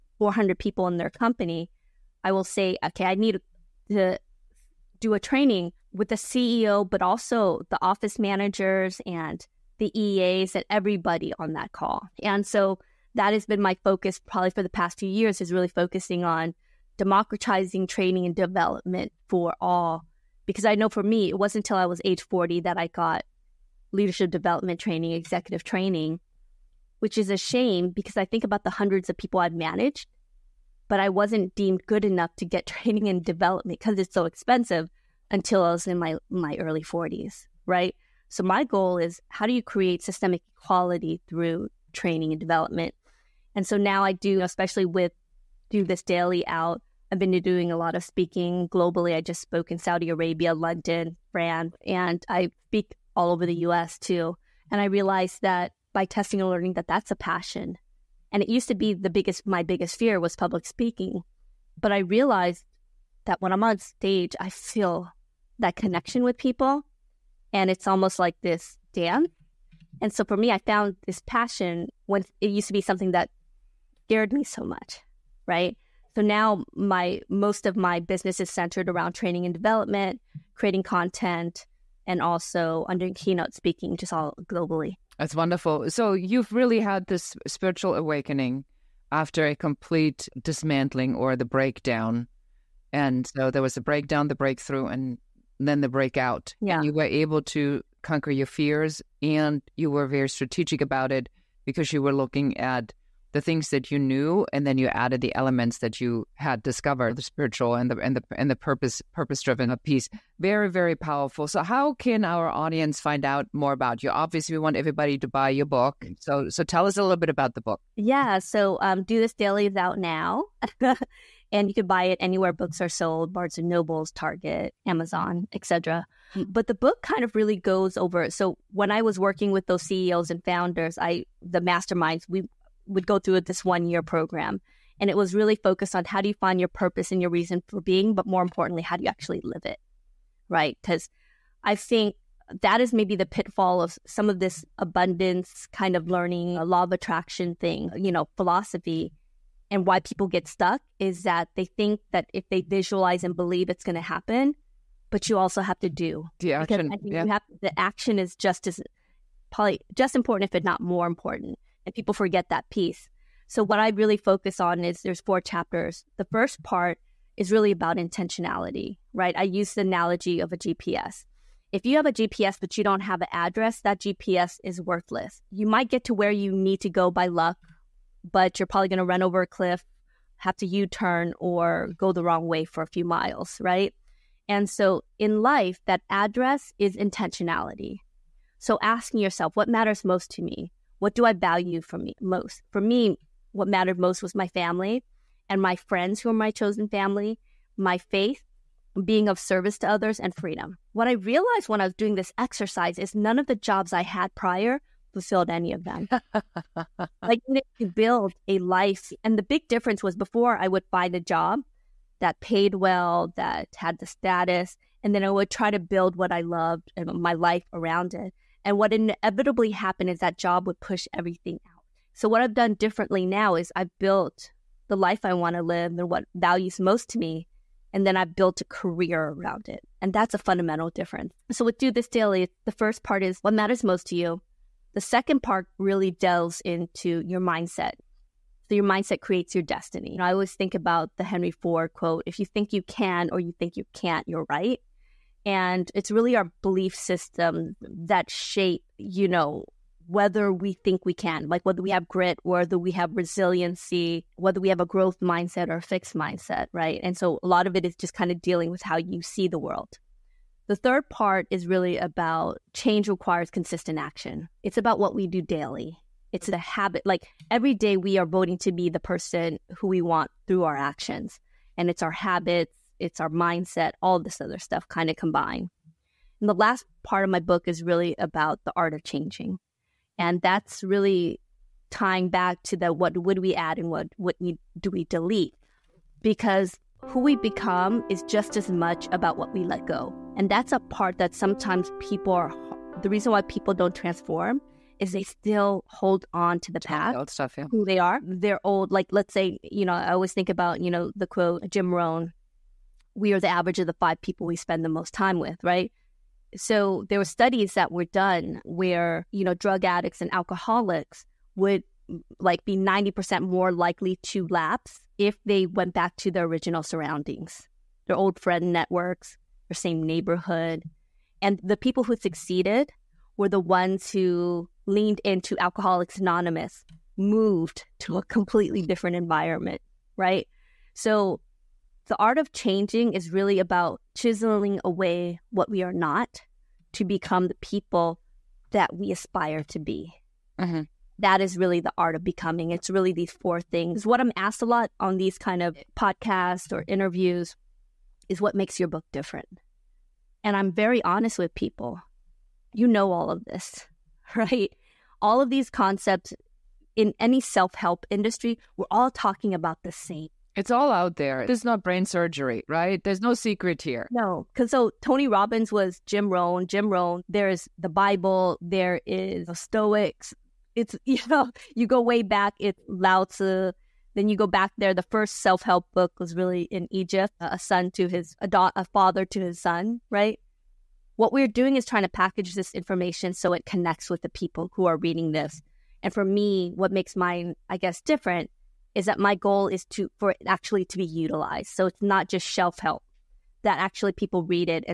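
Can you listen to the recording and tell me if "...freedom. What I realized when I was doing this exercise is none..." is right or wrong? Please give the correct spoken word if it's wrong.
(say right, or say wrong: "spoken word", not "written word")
right.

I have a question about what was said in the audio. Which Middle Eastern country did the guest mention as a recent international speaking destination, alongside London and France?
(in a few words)
Saudi Arabia.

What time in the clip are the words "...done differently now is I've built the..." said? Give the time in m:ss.
3:42.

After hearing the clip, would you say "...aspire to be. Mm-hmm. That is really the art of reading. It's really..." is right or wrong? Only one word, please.
wrong.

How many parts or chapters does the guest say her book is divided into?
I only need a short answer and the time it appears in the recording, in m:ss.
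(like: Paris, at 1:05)
4, at 2:45.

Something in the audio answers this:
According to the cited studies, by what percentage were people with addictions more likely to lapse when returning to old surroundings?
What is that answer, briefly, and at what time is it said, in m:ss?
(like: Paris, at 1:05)
90%, at 5:12.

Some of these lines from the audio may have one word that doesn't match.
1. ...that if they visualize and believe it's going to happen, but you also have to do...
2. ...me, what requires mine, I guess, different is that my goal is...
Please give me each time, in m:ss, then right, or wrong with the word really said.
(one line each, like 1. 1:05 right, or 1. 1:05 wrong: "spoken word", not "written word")
1. 2:32 right
2. 6:26 wrong: "makes", not "requires".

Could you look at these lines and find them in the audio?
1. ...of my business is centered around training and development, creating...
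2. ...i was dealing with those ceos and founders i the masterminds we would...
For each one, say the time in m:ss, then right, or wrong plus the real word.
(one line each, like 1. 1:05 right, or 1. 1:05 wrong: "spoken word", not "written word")
1. 1:17 right
2. 2:08 wrong: "working", not "dealing".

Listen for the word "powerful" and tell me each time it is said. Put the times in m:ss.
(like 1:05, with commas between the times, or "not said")
1:50.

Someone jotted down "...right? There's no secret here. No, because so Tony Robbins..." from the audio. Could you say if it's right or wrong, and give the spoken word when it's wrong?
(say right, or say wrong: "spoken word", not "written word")
right.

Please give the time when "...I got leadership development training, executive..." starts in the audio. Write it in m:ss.
0:22.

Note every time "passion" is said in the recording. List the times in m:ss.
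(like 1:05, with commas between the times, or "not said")
0:57, 1:11.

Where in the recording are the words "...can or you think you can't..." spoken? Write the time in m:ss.
4:02.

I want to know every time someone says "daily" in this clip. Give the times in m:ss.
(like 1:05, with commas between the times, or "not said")
0:46, 1:59, 3:52, 4:25.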